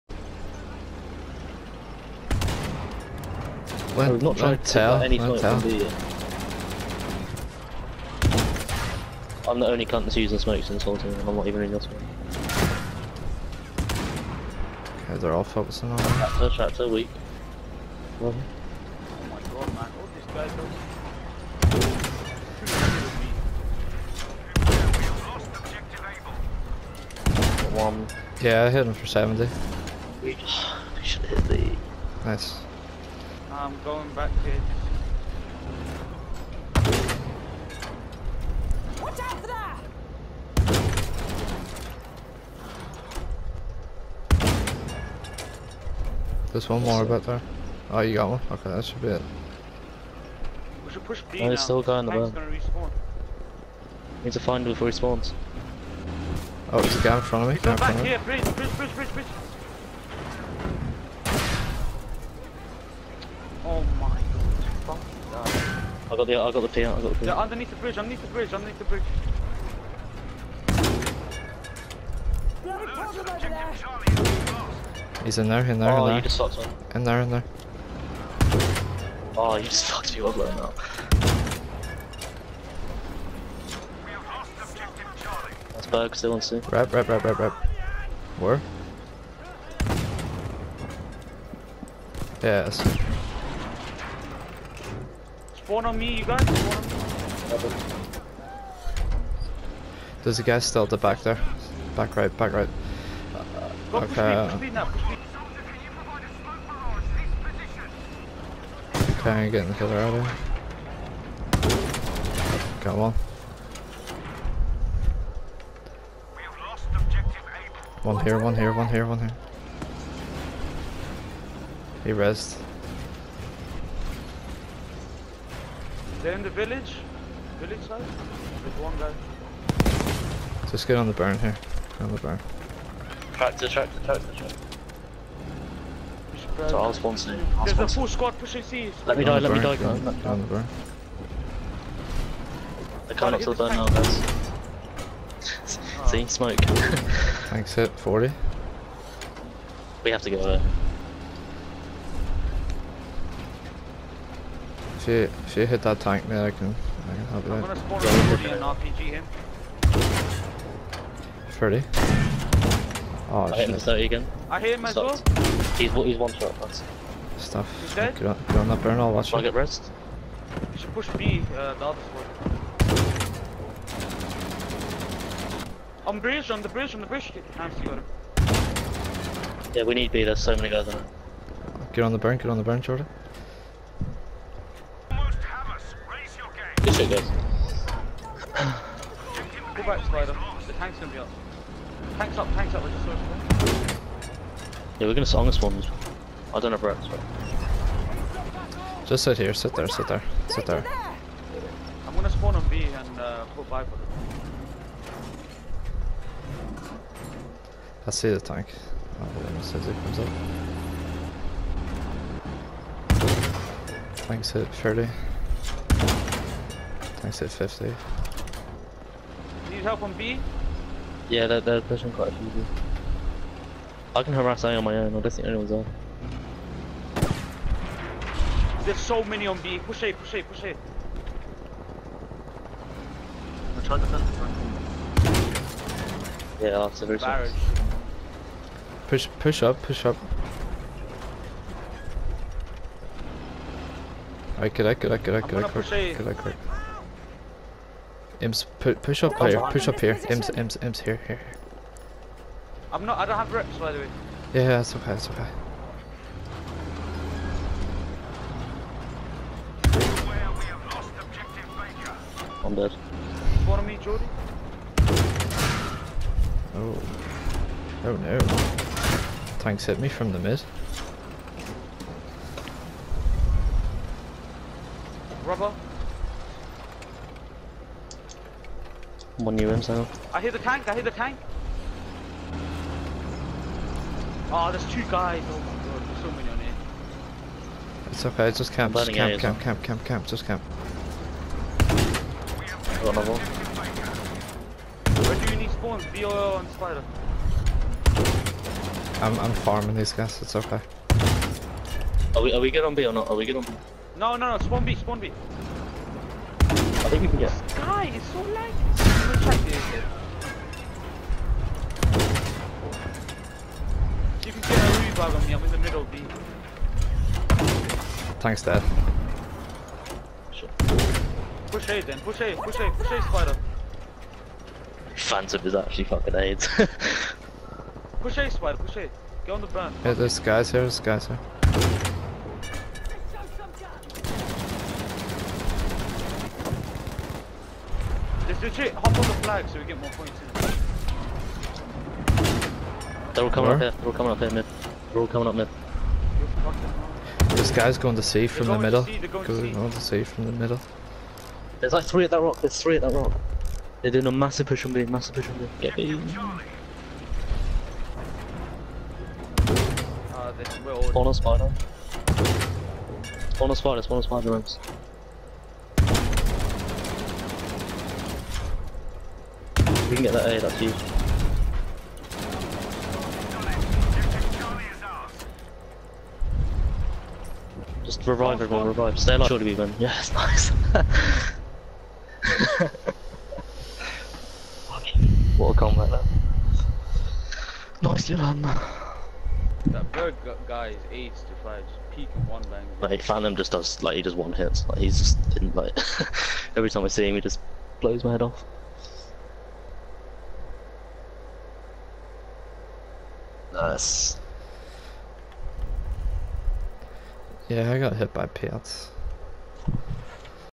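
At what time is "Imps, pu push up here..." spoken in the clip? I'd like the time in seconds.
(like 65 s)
248 s.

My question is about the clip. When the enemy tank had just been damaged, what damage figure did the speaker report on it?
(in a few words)
50.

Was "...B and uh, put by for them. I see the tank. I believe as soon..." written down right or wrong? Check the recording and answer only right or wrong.
right.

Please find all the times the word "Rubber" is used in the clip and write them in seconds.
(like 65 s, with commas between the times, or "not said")
275 s.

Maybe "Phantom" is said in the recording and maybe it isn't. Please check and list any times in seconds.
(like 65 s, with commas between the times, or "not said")
325 s, 393 s.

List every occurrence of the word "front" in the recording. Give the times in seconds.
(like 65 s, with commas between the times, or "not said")
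57 s, 234 s.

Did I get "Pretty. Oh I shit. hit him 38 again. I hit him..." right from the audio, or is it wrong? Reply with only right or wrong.
wrong.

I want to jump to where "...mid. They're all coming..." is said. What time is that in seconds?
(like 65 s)
344 s.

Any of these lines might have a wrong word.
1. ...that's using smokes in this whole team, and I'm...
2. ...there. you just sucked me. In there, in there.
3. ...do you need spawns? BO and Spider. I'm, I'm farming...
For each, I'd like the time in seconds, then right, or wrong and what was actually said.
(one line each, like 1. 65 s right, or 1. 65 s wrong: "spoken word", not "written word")
1. 10 s right
2. 76 s right
3. 295 s right.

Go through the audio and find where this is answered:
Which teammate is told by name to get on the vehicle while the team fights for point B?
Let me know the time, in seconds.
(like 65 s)
182 s.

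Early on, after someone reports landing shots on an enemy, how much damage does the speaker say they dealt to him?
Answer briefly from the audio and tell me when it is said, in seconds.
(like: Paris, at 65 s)
70, at 29 s.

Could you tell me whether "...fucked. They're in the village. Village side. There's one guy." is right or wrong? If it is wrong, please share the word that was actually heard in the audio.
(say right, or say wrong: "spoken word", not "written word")
wrong: "rezzed", not "fucked".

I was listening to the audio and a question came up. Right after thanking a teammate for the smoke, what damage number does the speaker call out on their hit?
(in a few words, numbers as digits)
40.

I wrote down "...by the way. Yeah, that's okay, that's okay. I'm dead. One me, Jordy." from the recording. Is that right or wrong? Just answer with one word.
right.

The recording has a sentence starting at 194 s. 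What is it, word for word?
Yeah, we're gonna sit on this one.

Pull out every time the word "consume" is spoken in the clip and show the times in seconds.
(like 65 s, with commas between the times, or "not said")
not said.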